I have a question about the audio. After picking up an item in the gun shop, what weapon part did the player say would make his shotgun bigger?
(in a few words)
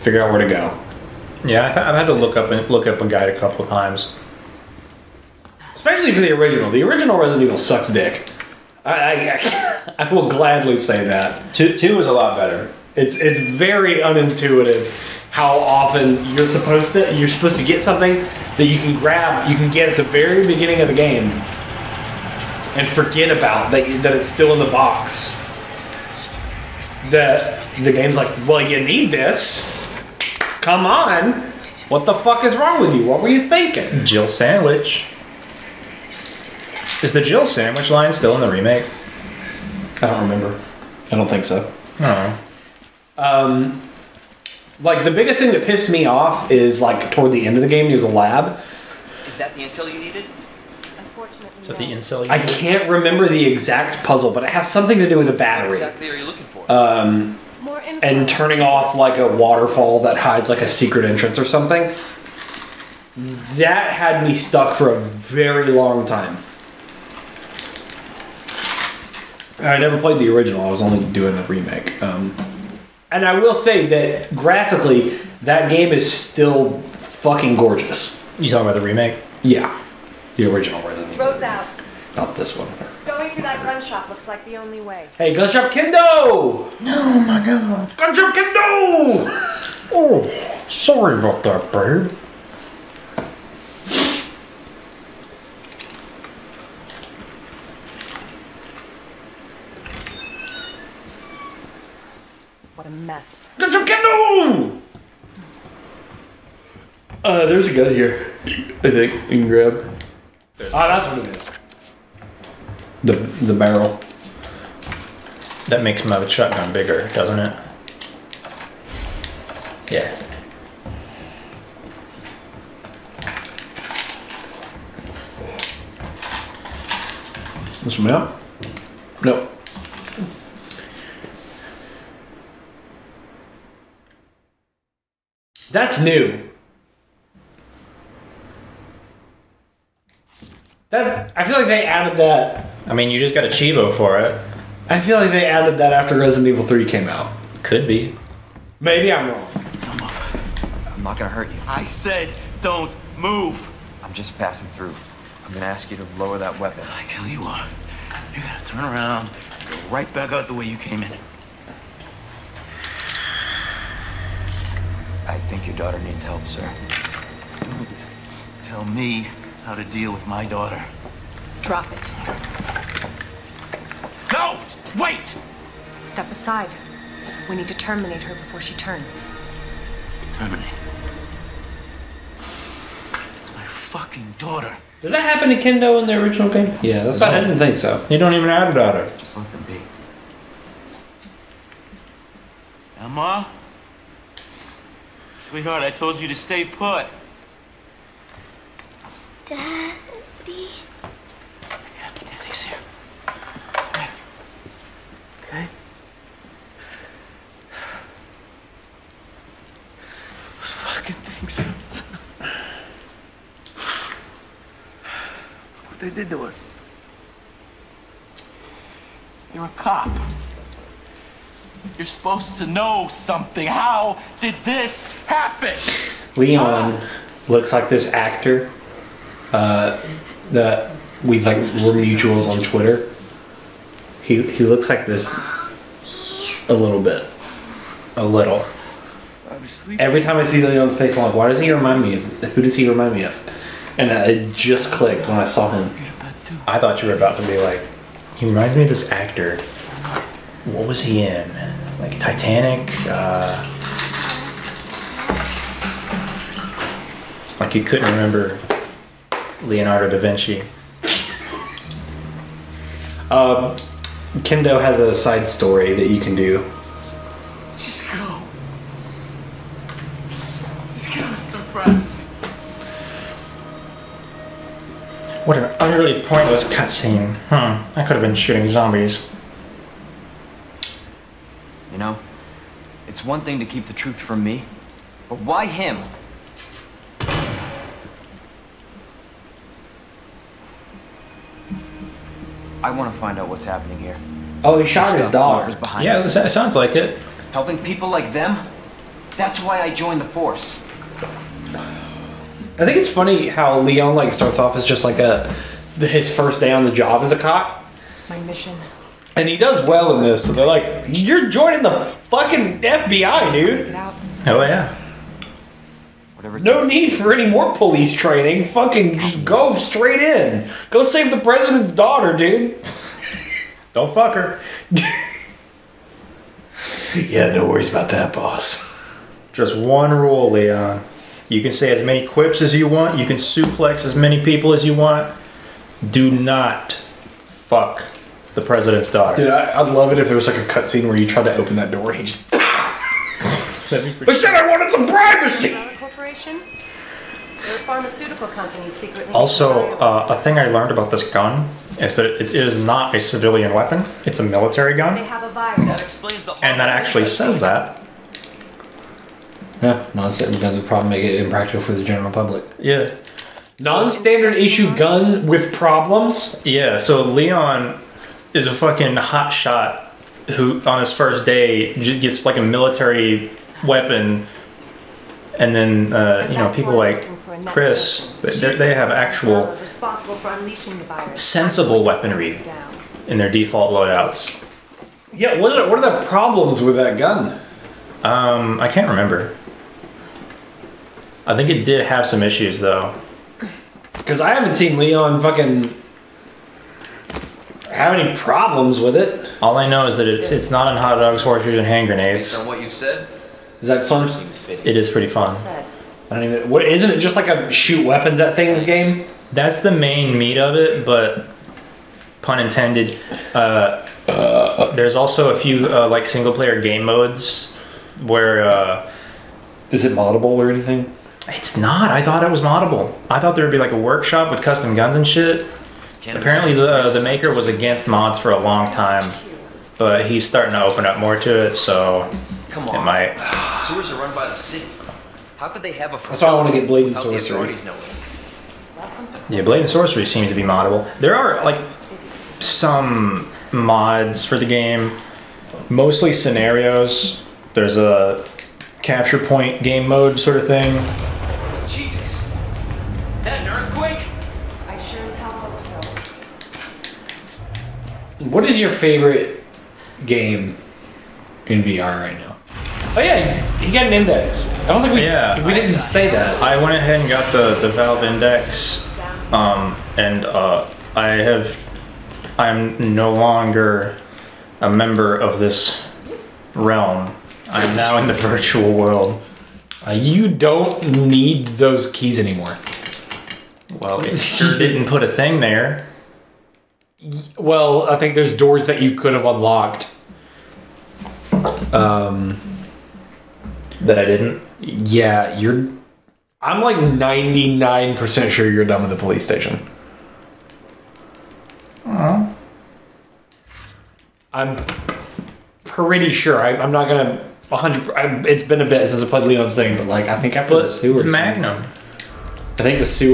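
The barrel.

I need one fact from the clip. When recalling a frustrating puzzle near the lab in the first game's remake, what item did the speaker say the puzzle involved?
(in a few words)
A battery.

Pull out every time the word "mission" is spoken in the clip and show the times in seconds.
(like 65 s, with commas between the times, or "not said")
308 s.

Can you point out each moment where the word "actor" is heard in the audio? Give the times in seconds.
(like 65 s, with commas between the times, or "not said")
228 s, 249 s.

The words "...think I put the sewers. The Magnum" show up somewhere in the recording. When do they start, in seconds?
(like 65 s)
510 s.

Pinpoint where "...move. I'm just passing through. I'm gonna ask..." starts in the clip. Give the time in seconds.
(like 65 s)
153 s.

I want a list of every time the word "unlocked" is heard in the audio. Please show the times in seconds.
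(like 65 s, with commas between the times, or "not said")
489 s.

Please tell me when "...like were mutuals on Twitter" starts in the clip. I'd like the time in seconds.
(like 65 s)
231 s.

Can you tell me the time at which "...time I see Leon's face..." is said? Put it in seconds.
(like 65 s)
240 s.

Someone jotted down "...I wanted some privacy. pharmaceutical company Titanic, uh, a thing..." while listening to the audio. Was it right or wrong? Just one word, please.
wrong.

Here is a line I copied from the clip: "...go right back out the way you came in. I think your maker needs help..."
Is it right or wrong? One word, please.
wrong.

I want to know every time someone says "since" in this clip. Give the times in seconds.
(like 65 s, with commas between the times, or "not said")
509 s.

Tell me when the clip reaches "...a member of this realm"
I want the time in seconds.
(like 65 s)
474 s.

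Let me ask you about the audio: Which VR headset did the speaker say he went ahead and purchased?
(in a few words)
Valve Index.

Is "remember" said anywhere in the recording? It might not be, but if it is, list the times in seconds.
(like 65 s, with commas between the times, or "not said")
40 s, 52 s, 258 s, 389 s.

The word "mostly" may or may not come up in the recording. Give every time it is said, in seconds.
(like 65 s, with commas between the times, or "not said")
445 s.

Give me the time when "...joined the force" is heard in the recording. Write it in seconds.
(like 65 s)
299 s.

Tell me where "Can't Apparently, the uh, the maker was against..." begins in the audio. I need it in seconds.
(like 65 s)
426 s.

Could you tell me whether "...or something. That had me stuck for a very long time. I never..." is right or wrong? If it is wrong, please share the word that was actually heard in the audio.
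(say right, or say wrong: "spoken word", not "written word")
right.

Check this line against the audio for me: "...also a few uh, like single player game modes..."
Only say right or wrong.
right.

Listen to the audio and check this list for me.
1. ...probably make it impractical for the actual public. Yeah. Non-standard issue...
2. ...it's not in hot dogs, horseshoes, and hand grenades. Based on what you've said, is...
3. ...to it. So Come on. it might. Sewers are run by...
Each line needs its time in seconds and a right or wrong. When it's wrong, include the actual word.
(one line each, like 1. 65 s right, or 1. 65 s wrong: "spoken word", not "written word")
1. 360 s wrong: "general", not "actual"
2. 400 s right
3. 431 s right.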